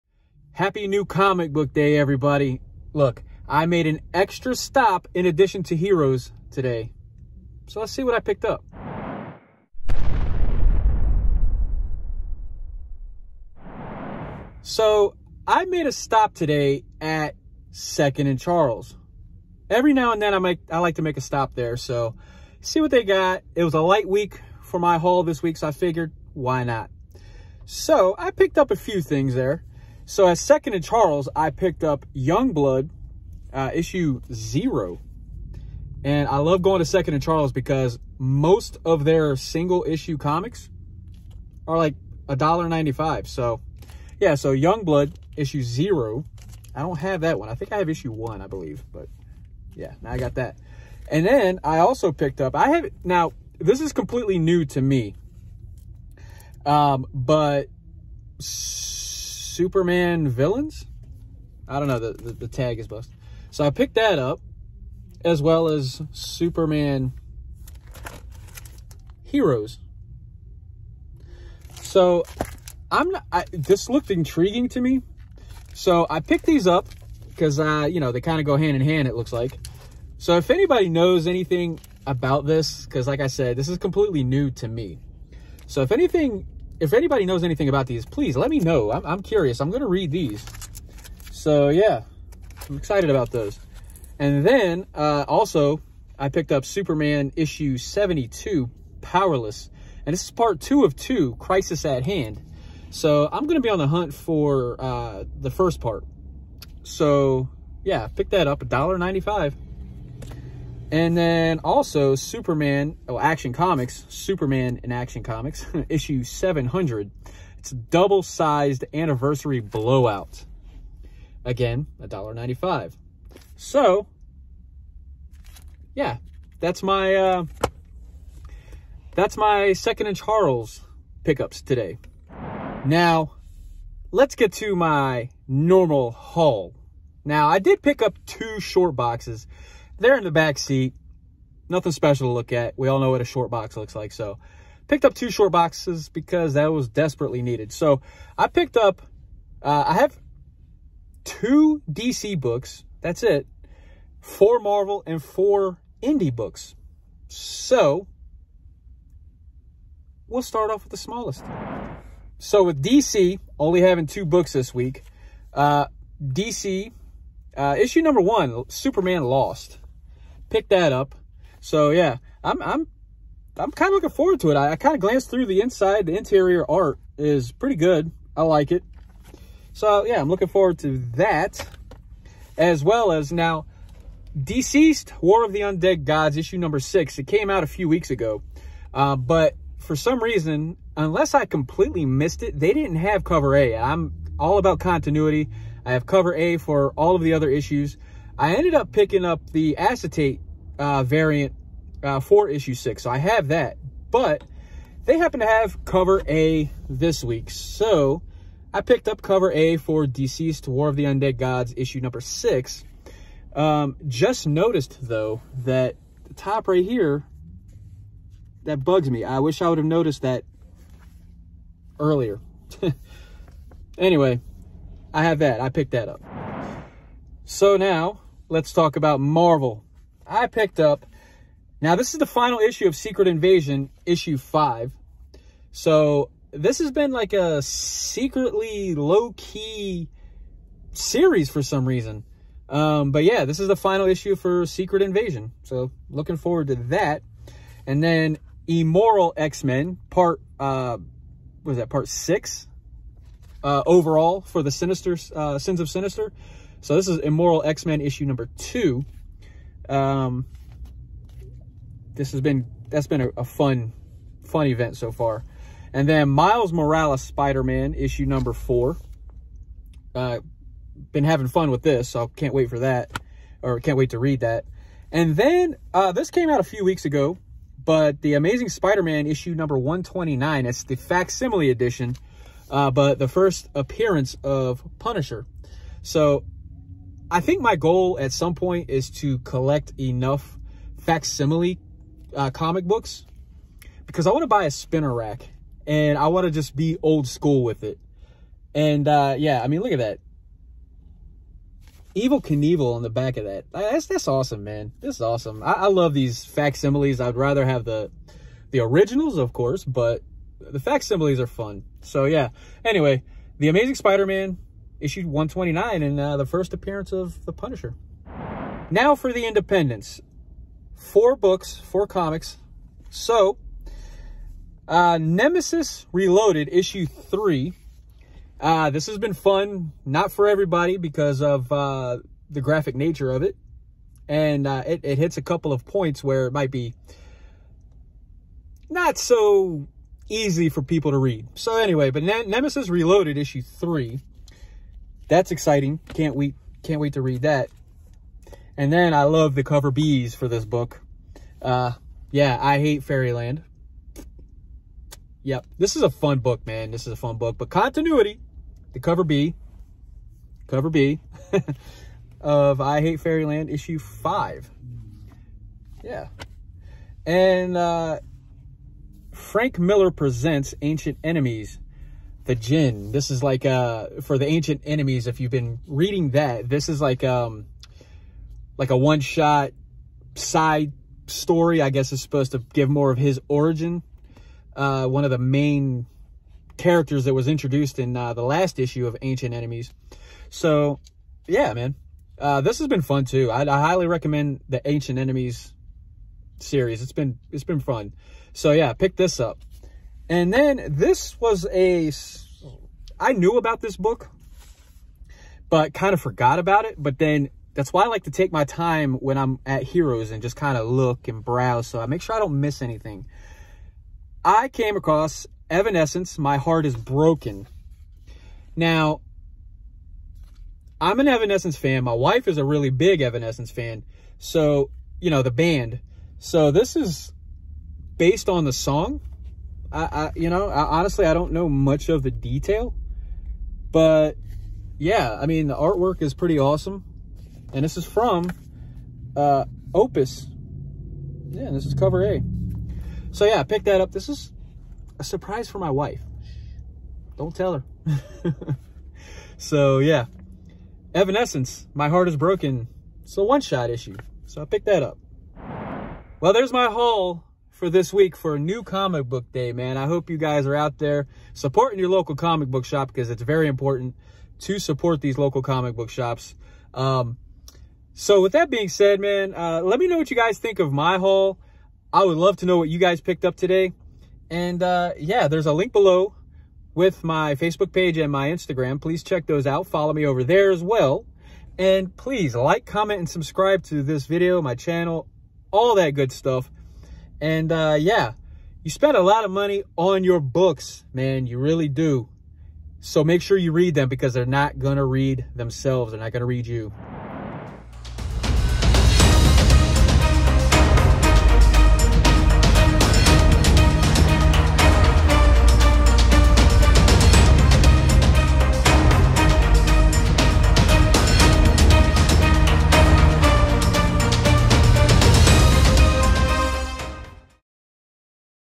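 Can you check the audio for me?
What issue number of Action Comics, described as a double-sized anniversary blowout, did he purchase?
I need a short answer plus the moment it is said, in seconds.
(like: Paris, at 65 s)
700, at 115 s.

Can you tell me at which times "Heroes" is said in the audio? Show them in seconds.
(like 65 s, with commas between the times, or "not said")
5 s, 69 s, 409 s.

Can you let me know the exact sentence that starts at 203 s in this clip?
So I have that, but they happen to have cover A this week.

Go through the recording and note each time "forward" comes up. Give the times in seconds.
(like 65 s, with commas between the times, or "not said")
174 s, 180 s, 246 s.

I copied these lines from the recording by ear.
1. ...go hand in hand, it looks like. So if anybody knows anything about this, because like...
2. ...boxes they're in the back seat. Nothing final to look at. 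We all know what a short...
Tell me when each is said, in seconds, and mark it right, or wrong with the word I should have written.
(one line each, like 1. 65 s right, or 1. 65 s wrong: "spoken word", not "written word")
1. 78 s right
2. 138 s wrong: "special", not "final".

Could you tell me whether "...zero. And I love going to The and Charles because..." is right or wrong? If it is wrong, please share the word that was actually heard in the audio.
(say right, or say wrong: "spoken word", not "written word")
wrong: "Second", not "The".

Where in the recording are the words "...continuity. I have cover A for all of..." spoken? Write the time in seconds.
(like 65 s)
194 s.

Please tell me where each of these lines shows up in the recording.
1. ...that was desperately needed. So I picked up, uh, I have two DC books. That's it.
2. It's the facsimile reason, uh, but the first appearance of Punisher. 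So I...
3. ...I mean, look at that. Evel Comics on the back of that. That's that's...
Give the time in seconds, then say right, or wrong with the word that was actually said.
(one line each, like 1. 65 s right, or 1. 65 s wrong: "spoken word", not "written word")
1. 146 s right
2. 280 s wrong: "edition", not "reason"
3. 299 s wrong: "Knievel", not "Comics".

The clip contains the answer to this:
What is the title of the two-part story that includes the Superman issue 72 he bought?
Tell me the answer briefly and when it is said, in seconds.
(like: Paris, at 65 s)
Crisis at Hand, at 101 s.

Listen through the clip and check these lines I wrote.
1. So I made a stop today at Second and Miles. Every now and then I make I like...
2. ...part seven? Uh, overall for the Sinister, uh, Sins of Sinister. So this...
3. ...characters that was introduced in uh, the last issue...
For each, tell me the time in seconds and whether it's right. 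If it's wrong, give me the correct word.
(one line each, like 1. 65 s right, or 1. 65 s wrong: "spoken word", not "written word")
1. 14 s wrong: "Charles", not "Miles"
2. 251 s wrong: "six", not "seven"
3. 386 s right.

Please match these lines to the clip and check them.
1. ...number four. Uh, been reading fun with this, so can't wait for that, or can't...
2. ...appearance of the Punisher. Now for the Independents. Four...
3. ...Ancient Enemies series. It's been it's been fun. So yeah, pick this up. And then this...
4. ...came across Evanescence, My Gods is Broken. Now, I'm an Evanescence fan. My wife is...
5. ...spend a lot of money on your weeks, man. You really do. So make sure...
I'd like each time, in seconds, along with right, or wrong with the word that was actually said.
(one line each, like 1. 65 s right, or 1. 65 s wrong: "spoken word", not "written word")
1. 268 s wrong: "having", not "reading"
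2. 316 s right
3. 394 s right
4. 414 s wrong: "Heart", not "Gods"
5. 488 s wrong: "books", not "weeks".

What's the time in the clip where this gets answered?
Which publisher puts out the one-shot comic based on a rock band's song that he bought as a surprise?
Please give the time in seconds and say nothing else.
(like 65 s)
439 s.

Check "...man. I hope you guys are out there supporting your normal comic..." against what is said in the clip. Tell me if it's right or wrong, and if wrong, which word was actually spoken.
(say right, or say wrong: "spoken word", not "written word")
wrong: "local", not "normal".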